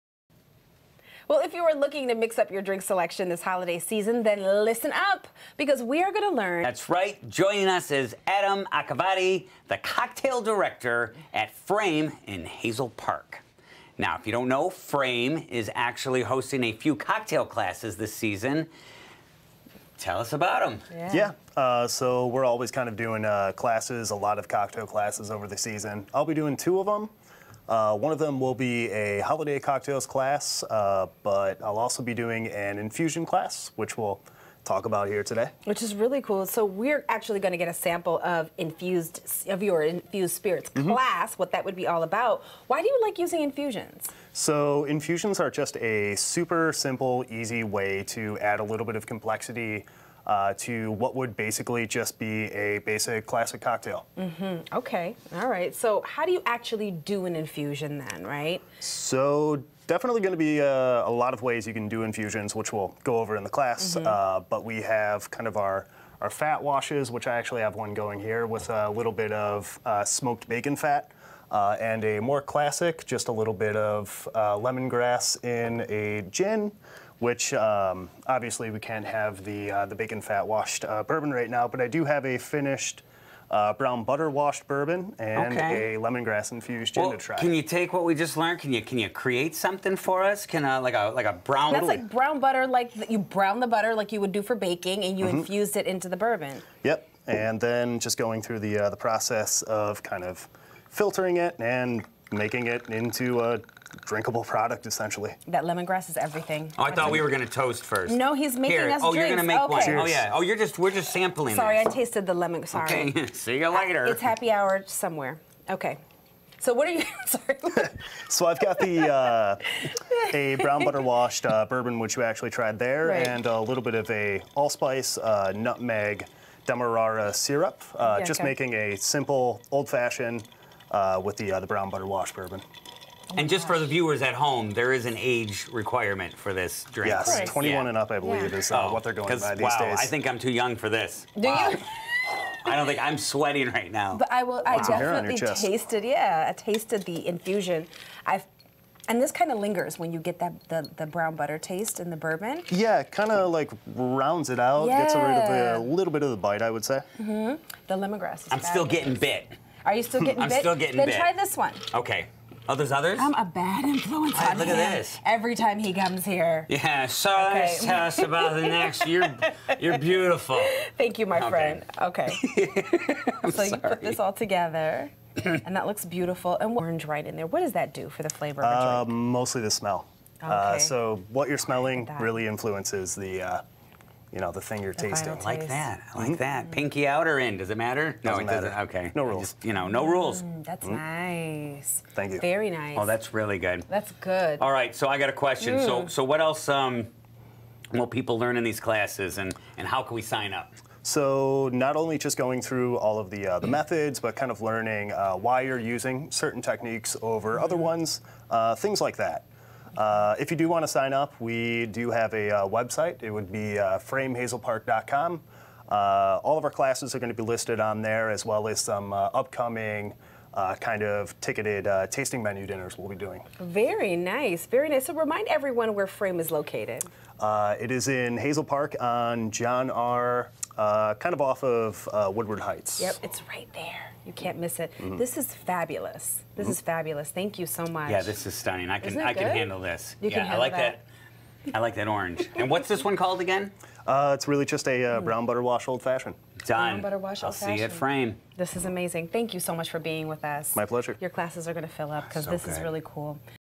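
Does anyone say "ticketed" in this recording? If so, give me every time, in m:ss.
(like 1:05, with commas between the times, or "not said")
3:41.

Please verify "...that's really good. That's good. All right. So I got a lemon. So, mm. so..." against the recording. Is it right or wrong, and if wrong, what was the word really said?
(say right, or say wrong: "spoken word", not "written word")
wrong: "question", not "lemon".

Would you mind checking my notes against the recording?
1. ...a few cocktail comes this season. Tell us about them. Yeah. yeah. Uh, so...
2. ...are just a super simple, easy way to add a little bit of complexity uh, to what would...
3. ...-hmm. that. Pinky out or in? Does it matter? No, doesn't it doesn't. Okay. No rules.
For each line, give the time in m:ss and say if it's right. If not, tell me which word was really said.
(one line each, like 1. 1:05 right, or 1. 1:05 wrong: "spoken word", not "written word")
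1. 0:16 wrong: "classes", not "comes"
2. 0:45 right
3. 3:06 right.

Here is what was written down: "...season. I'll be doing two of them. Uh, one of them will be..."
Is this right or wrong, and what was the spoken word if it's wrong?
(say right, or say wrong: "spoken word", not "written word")
right.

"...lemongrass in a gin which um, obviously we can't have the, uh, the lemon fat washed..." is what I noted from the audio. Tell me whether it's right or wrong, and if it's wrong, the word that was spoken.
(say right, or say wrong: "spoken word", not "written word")
wrong: "bacon", not "lemon".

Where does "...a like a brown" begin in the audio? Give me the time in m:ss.
1:30.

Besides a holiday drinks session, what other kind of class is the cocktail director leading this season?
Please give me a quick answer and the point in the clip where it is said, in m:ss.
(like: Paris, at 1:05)
Infusion class, at 0:32.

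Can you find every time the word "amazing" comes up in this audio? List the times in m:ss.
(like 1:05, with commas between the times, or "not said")
4:08.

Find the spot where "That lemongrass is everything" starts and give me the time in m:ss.
1:45.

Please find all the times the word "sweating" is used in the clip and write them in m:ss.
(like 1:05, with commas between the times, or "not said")
2:23.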